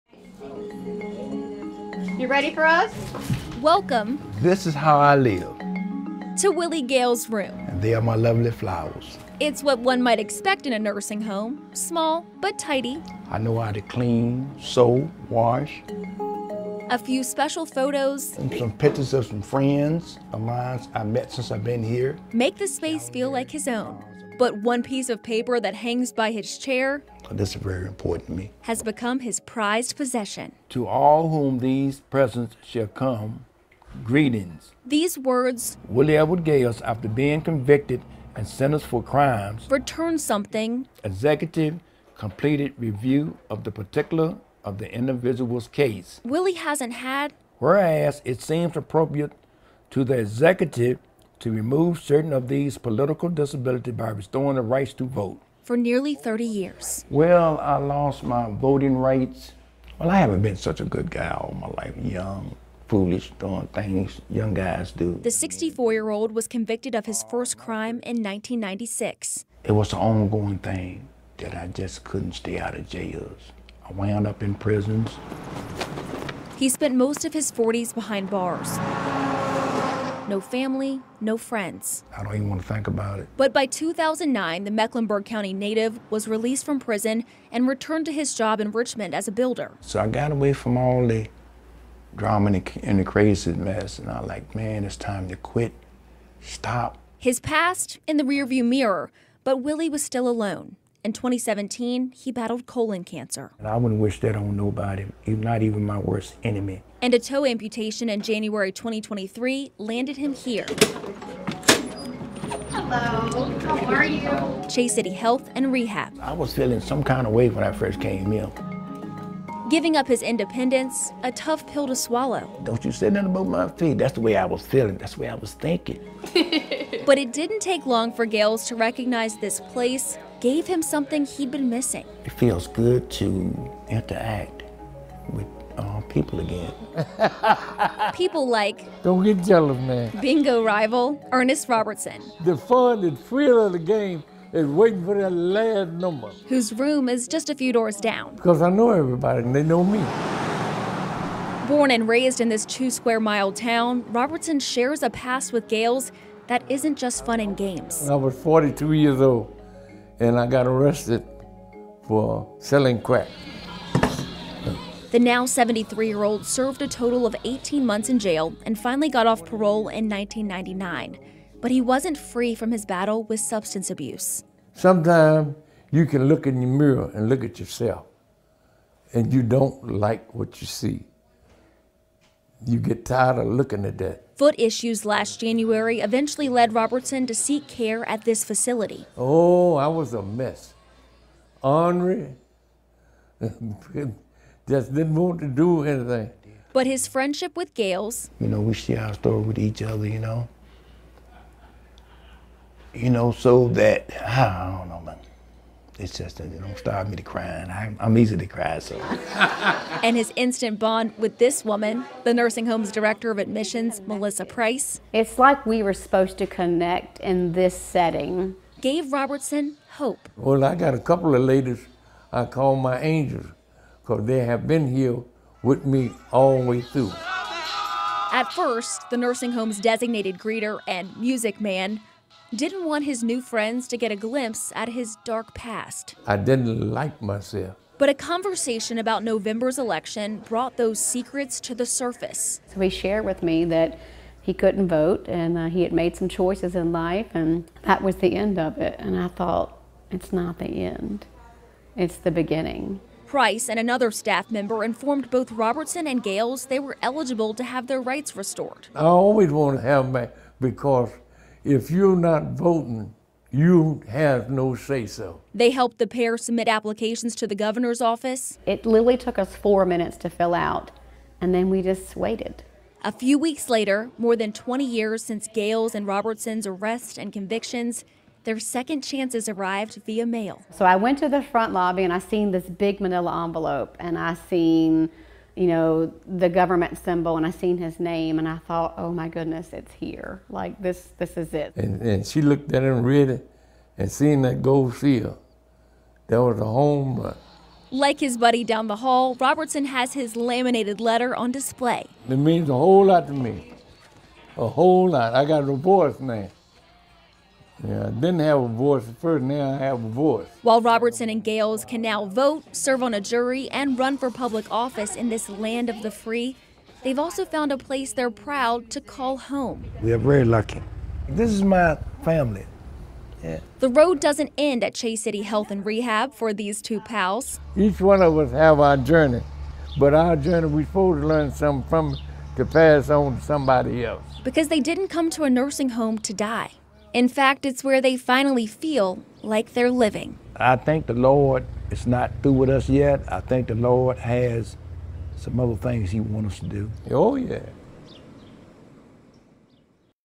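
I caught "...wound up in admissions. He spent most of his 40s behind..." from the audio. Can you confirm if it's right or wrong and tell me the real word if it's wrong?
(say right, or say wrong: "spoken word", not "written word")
wrong: "prisons", not "admissions".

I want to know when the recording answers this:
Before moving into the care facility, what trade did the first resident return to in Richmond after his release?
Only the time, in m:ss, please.
1:29.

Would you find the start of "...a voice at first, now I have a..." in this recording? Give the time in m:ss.
5:08.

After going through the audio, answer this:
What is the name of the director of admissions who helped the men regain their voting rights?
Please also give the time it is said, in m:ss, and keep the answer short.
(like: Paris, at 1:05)
Melissa Price, at 3:34.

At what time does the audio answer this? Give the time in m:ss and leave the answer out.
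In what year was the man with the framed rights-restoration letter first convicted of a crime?
1:08.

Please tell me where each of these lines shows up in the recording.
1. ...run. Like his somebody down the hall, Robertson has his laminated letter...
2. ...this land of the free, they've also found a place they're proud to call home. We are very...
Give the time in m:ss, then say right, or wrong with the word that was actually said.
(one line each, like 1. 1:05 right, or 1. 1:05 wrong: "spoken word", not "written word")
1. 4:57 wrong: "buddy", not "somebody"
2. 5:15 right.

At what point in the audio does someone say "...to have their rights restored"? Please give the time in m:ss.
4:17.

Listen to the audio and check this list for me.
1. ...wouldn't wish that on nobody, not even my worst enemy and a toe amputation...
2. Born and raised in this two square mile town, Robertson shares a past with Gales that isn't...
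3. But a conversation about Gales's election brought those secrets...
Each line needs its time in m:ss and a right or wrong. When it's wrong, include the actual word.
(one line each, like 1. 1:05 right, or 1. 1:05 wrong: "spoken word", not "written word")
1. 1:43 right
2. 2:31 right
3. 3:57 wrong: "November", not "Gales".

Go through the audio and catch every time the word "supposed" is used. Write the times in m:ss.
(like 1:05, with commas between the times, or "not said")
3:35, 5:30.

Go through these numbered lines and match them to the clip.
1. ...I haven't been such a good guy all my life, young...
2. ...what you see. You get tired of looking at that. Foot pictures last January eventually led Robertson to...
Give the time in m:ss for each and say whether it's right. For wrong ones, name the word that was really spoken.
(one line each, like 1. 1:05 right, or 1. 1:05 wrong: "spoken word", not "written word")
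1. 1:00 right
2. 3:00 wrong: "issues", not "pictures".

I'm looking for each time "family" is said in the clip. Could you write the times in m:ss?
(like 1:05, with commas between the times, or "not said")
1:20, 5:22.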